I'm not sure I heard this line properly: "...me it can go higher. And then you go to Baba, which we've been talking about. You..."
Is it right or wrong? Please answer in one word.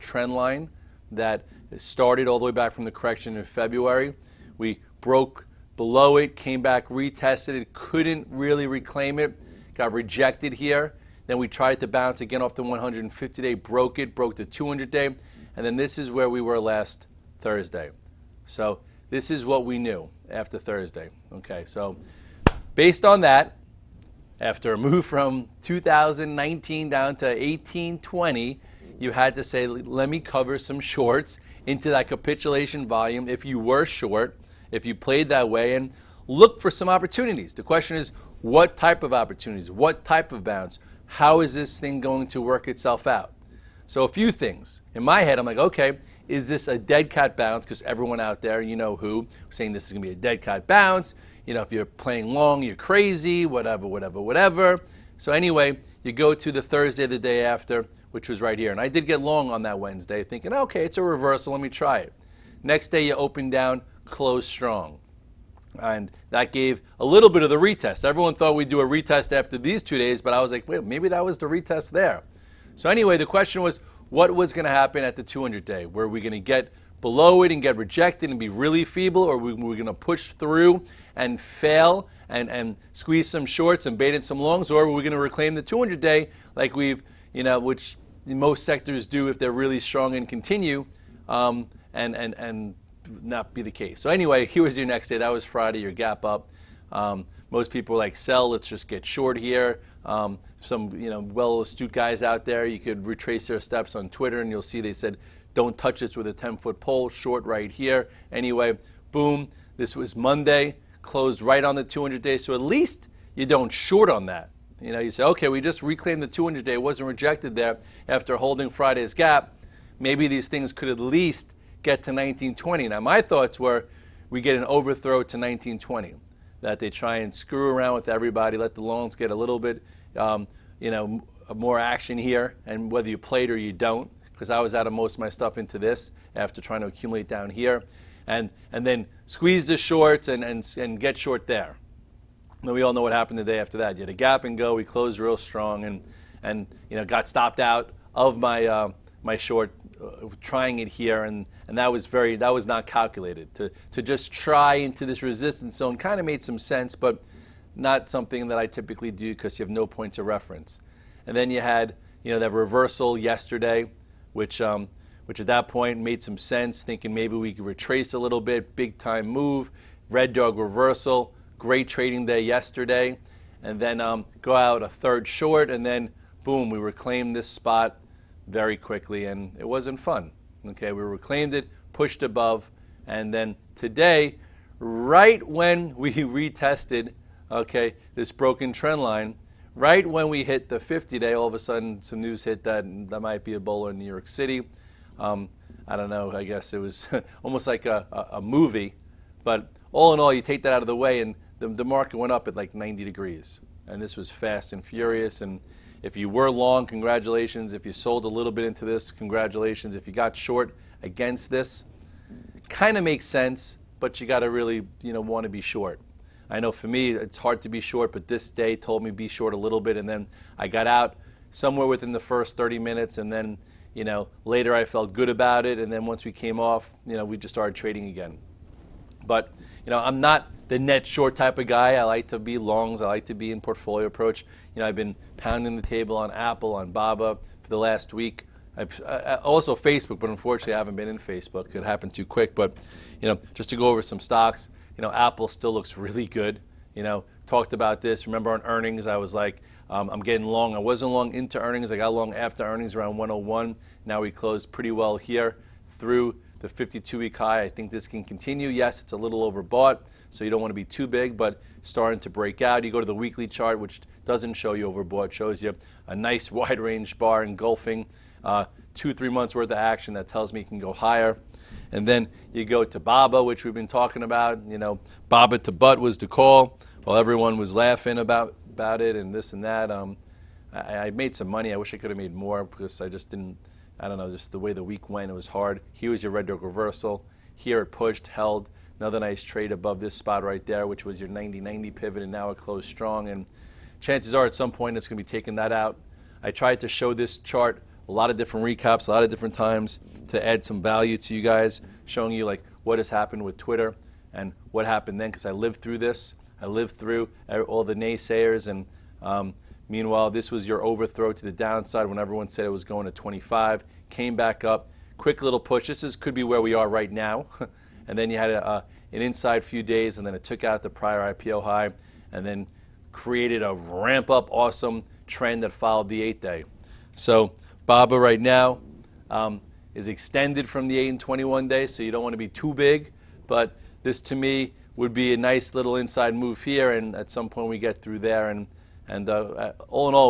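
right.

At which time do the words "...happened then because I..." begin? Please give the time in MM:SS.
05:04.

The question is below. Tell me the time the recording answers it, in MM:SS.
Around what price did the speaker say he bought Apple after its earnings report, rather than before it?
04:13.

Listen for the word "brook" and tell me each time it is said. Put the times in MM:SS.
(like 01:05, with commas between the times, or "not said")
not said.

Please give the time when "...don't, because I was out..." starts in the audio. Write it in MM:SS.
02:13.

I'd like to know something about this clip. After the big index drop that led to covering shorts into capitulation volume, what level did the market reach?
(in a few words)
1820.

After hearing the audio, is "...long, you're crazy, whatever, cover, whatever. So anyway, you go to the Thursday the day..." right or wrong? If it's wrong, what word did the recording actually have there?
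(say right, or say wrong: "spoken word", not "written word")
wrong: "whatever", not "cover".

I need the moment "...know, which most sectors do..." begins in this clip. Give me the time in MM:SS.
01:27.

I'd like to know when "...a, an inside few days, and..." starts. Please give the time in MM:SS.
05:18.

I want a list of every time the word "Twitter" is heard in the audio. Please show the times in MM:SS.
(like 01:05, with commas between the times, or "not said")
01:44, 05:03.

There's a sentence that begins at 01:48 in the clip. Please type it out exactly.
Anyway, boom, this was Monday closed right on the 200 day.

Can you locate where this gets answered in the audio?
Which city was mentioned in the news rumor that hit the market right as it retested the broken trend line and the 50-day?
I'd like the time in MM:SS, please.
03:13.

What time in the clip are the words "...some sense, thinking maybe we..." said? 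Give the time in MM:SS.
02:46.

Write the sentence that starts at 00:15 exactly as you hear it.
And then this is where we were last Thursday.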